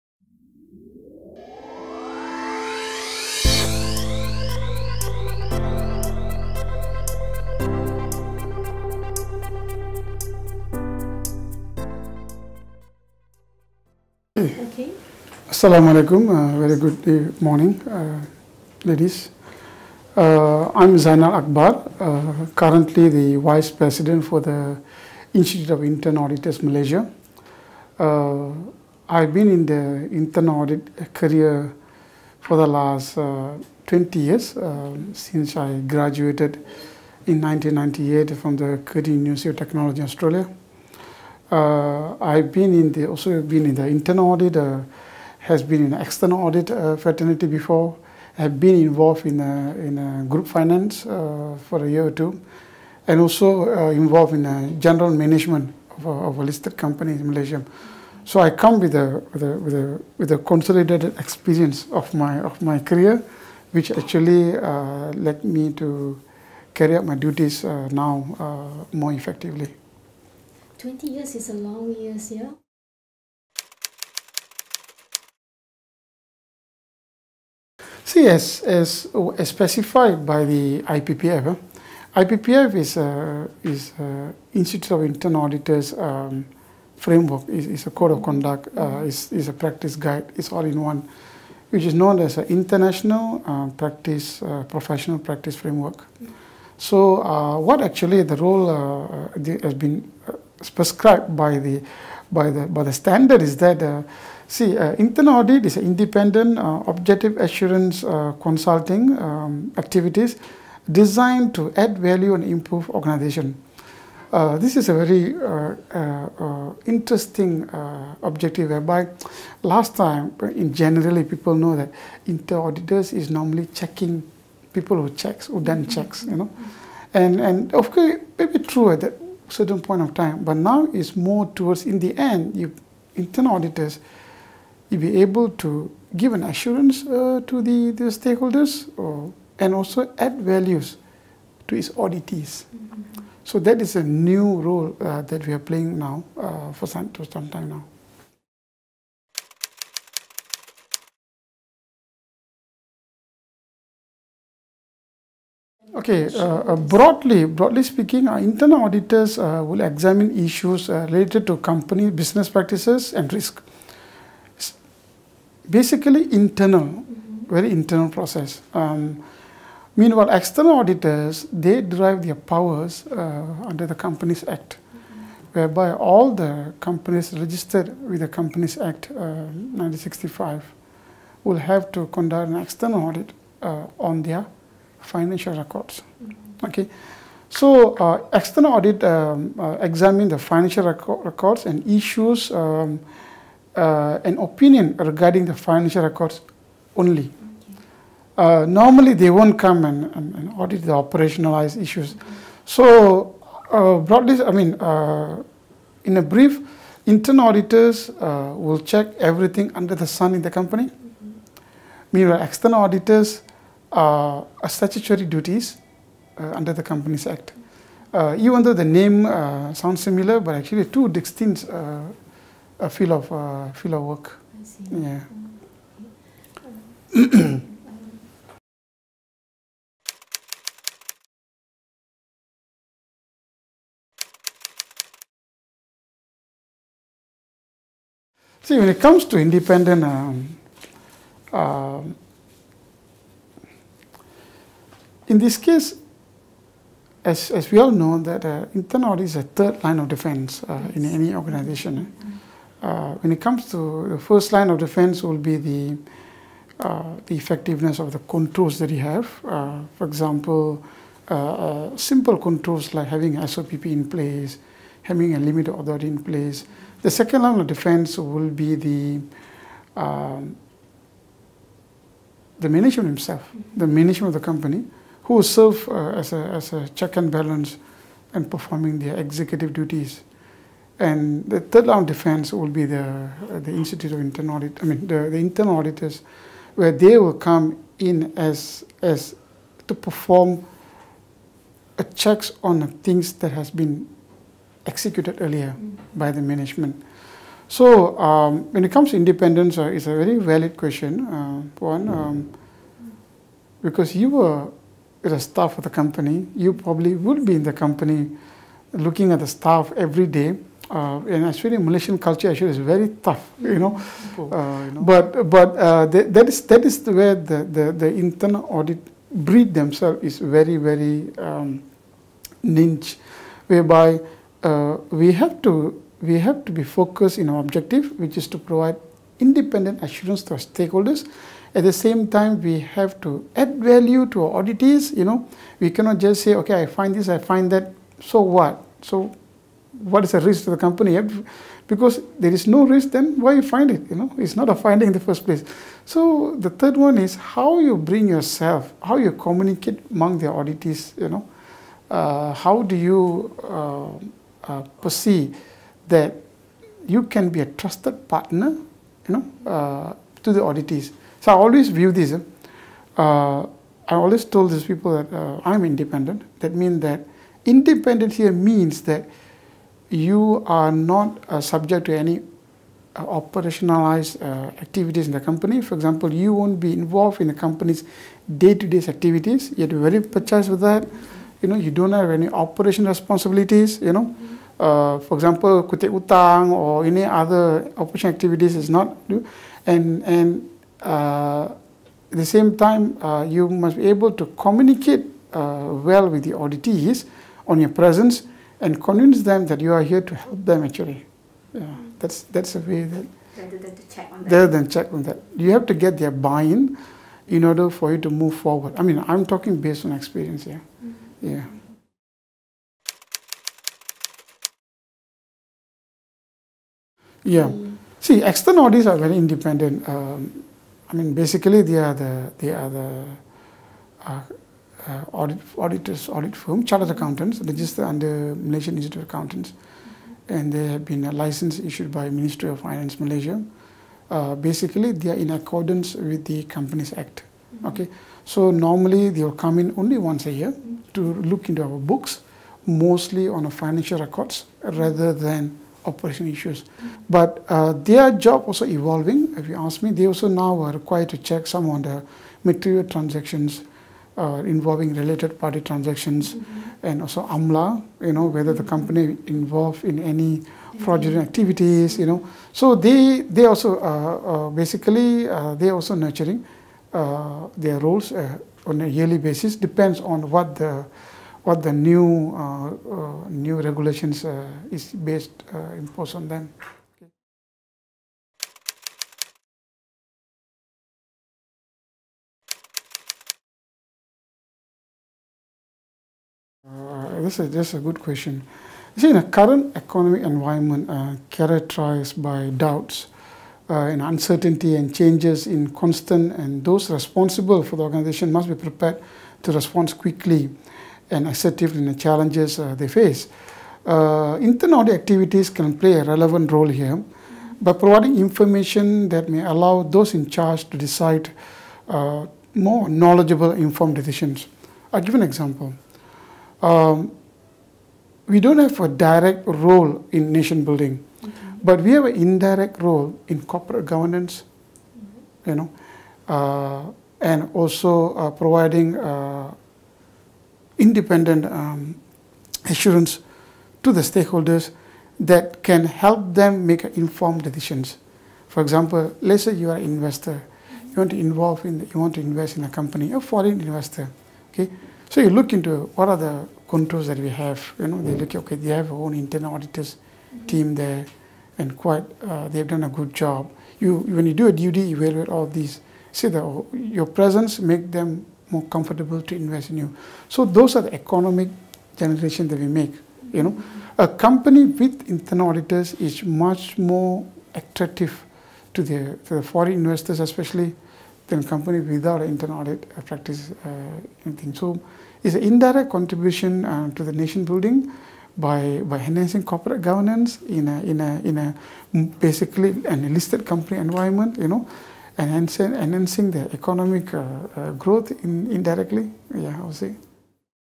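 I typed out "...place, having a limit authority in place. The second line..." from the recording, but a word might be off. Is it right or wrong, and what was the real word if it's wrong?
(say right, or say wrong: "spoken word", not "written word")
right.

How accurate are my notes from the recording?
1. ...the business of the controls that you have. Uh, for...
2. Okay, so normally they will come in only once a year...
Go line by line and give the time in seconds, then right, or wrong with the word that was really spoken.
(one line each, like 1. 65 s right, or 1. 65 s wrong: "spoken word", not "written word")
1. 257 s wrong: "effectiveness", not "business"
2. 437 s right.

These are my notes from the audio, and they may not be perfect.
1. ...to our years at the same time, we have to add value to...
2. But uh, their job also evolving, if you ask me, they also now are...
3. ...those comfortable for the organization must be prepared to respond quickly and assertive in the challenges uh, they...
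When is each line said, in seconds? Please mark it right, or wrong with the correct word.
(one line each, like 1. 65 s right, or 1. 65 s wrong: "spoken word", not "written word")
1. 330 s wrong: "stakeholders", not "years"
2. 447 s right
3. 496 s wrong: "responsible", not "comfortable".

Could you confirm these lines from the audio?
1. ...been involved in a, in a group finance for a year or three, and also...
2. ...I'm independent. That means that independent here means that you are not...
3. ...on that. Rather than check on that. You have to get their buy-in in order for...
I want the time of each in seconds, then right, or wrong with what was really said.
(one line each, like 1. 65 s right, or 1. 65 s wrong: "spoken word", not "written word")
1. 48 s wrong: "two", not "three"
2. 365 s right
3. 404 s right.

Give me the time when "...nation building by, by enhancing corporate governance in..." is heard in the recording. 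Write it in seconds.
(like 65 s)
577 s.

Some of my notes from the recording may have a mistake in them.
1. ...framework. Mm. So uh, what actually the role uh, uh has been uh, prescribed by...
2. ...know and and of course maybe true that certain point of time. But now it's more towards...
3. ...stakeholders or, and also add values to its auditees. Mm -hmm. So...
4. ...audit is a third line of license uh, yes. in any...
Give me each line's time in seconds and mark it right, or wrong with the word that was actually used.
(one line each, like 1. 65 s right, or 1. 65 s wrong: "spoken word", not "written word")
1. 95 s right
2. 126 s right
3. 138 s right
4. 249 s wrong: "defense", not "license".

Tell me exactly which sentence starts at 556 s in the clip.
See that your presence make them more comfortable to invest in you.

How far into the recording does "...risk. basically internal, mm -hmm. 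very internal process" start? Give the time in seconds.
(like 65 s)
163 s.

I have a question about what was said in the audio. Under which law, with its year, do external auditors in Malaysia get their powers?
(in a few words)
Companies Act 1965.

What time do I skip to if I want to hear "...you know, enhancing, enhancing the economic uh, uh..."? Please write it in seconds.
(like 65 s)
584 s.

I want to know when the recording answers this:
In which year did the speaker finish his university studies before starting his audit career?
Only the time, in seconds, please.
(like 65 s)
37 s.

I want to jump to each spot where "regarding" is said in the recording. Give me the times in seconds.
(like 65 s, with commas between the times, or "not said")
194 s.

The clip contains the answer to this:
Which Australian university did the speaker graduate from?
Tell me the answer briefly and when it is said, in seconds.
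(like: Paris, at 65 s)
Curtin University of Technology, at 38 s.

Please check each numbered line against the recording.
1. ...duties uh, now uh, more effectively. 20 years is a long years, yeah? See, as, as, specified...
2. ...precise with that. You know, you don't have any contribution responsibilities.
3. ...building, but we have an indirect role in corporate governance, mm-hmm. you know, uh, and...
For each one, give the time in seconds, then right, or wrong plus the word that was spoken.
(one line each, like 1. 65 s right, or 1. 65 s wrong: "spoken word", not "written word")
1. 67 s right
2. 380 s wrong: "operation", not "contribution"
3. 520 s right.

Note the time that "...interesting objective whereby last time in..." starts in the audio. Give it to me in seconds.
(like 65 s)
116 s.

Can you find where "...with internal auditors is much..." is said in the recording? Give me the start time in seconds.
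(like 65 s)
564 s.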